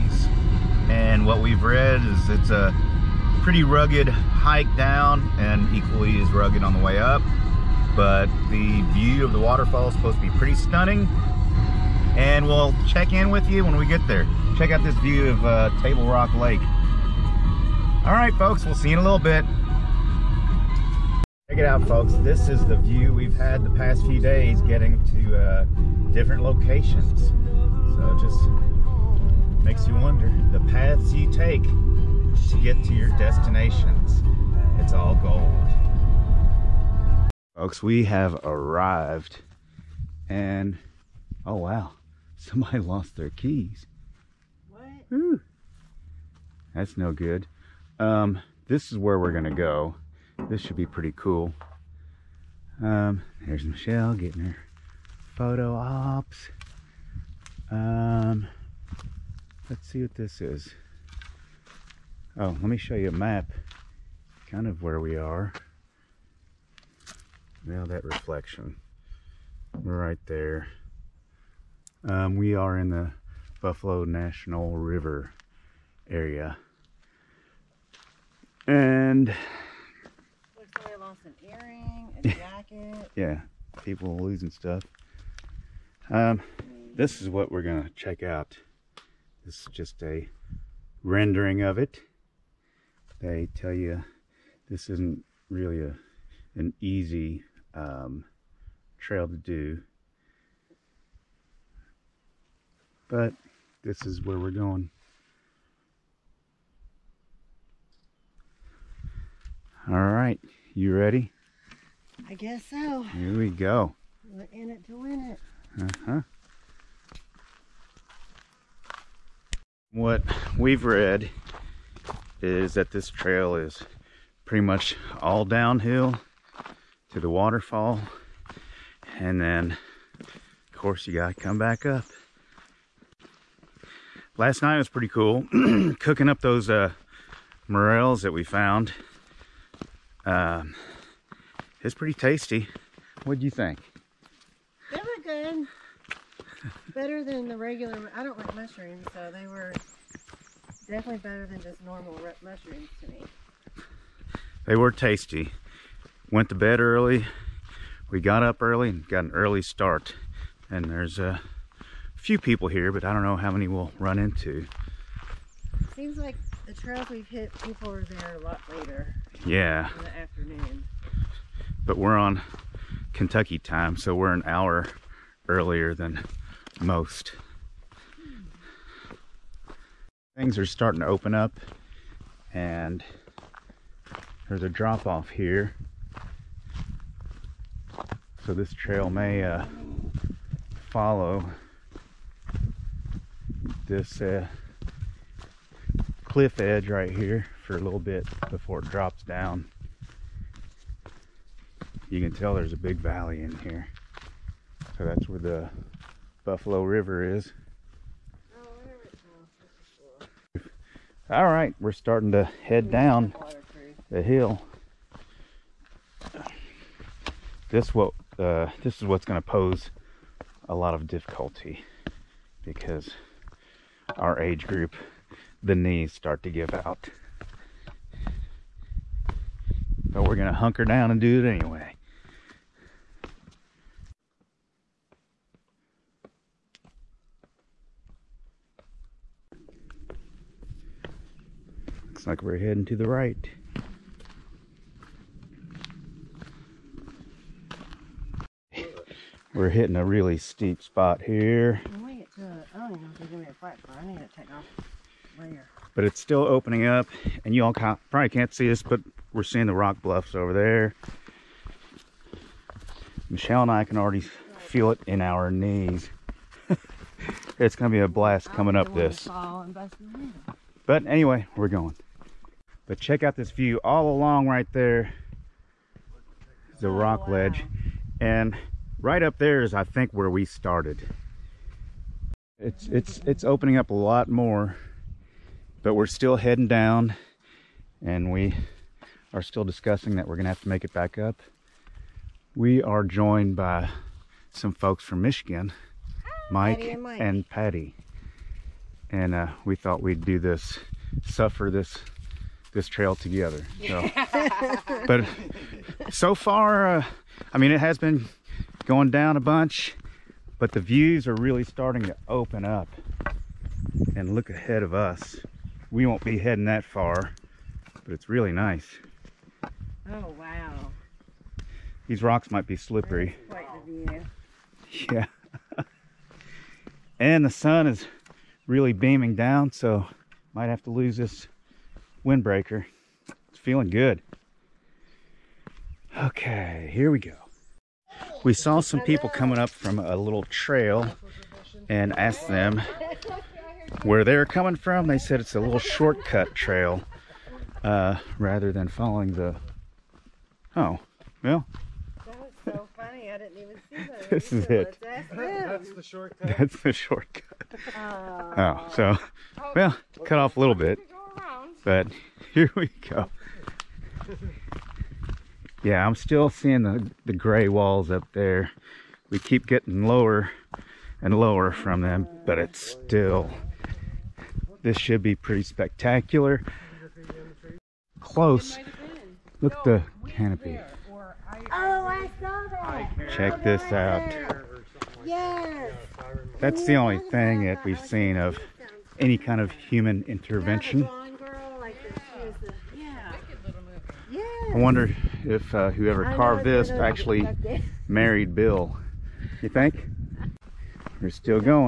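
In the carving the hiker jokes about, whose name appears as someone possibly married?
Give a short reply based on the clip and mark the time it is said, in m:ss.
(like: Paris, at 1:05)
Bill, at 6:38.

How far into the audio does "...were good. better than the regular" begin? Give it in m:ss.
2:24.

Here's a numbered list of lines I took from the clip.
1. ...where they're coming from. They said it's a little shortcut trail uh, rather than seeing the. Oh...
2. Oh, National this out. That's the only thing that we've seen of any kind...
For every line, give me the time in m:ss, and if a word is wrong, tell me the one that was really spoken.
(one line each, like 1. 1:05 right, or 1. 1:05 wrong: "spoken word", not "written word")
1. 5:44 wrong: "following", not "seeing"
2. 6:21 wrong: "Check", not "National".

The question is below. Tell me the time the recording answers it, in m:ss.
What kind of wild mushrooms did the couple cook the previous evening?
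2:17.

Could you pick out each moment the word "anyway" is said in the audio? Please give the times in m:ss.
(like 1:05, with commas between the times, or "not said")
3:51, 4:31.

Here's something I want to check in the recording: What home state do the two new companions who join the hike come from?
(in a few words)
Michigan.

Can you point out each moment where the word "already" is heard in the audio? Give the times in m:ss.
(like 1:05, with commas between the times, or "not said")
4:23.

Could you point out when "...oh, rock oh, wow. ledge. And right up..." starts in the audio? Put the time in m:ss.
4:36.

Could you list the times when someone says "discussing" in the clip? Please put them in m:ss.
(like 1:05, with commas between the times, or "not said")
4:49.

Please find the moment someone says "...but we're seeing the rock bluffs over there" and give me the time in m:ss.
4:18.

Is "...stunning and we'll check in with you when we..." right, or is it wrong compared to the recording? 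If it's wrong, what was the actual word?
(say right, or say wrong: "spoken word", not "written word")
right.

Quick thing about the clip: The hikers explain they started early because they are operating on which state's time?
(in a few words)
Kentucky.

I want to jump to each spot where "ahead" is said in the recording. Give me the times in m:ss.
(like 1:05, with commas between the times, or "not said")
5:14.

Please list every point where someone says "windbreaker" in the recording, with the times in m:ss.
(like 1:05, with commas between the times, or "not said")
5:32.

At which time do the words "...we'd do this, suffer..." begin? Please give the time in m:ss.
5:00.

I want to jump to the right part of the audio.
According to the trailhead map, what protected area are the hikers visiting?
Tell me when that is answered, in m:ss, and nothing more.
1:13.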